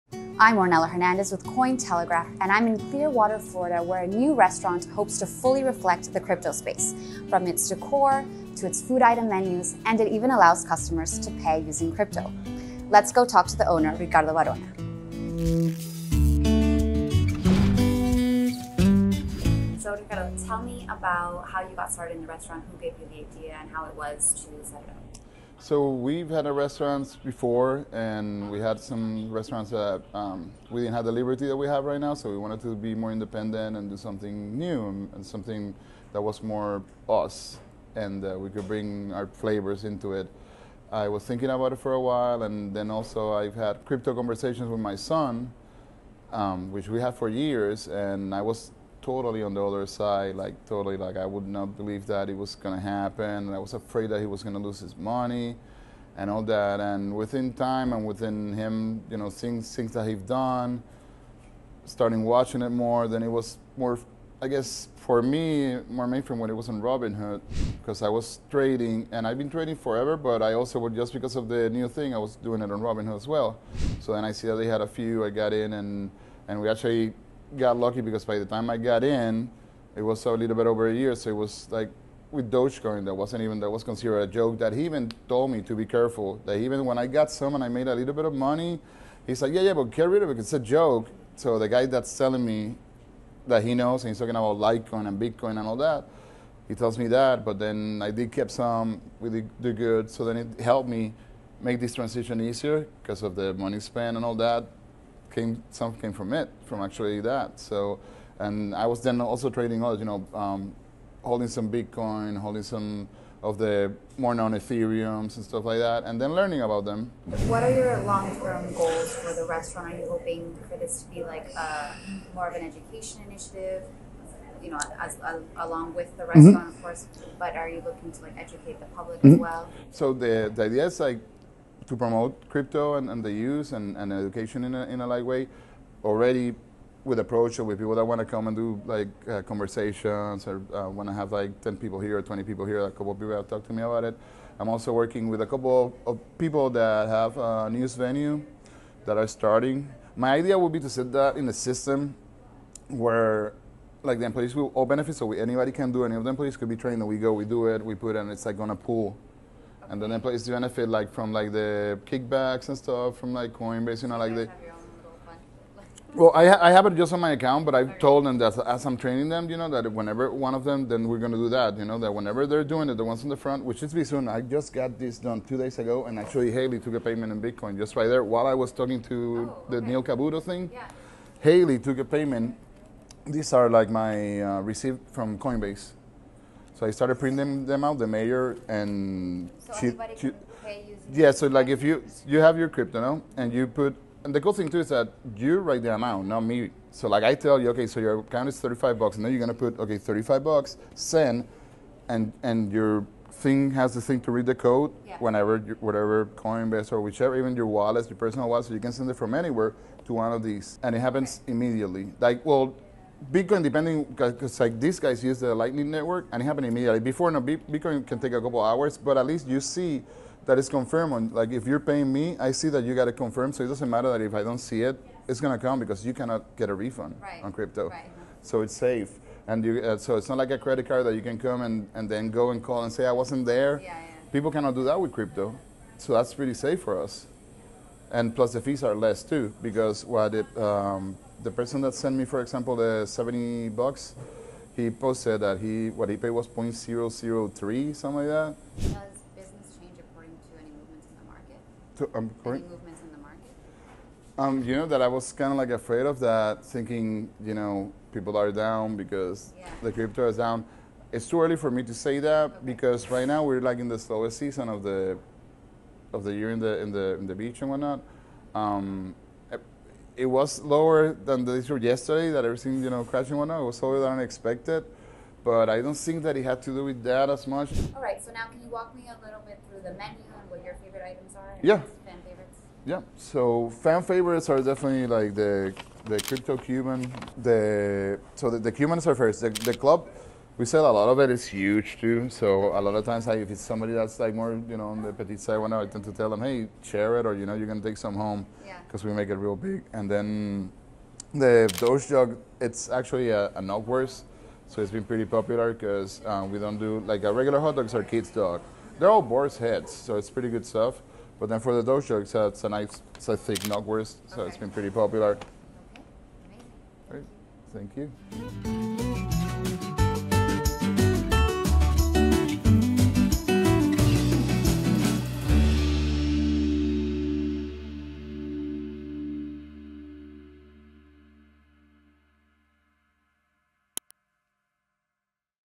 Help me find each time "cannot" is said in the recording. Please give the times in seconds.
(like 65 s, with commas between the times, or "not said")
226 s, 234 s.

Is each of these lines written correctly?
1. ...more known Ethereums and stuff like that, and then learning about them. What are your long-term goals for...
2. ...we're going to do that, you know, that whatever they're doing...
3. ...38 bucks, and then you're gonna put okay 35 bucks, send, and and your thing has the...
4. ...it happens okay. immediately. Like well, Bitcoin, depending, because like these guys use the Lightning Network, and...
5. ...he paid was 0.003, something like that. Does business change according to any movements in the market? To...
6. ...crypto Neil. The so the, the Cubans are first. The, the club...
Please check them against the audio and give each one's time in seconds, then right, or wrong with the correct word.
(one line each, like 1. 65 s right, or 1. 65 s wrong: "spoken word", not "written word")
1. 114 s right
2. 171 s wrong: "whenever", not "whatever"
3. 198 s wrong: "35", not "38"
4. 210 s right
5. 246 s right
6. 286 s wrong: "Cuban", not "Neil".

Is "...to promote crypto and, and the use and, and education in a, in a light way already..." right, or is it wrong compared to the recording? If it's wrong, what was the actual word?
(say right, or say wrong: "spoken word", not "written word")
right.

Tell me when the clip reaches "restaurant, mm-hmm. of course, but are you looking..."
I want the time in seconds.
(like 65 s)
126 s.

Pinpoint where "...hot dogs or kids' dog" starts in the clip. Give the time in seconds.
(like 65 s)
307 s.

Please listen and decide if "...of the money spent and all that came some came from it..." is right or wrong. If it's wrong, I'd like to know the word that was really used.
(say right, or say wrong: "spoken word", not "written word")
right.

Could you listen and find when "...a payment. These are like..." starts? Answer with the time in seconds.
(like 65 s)
181 s.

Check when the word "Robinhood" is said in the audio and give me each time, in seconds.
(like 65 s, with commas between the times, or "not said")
66 s, 72 s.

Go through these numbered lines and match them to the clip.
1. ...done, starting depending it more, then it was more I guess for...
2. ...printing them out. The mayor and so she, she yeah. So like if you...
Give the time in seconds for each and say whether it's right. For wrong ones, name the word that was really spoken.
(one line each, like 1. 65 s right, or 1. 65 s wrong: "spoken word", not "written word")
1. 60 s wrong: "watching", not "depending"
2. 187 s right.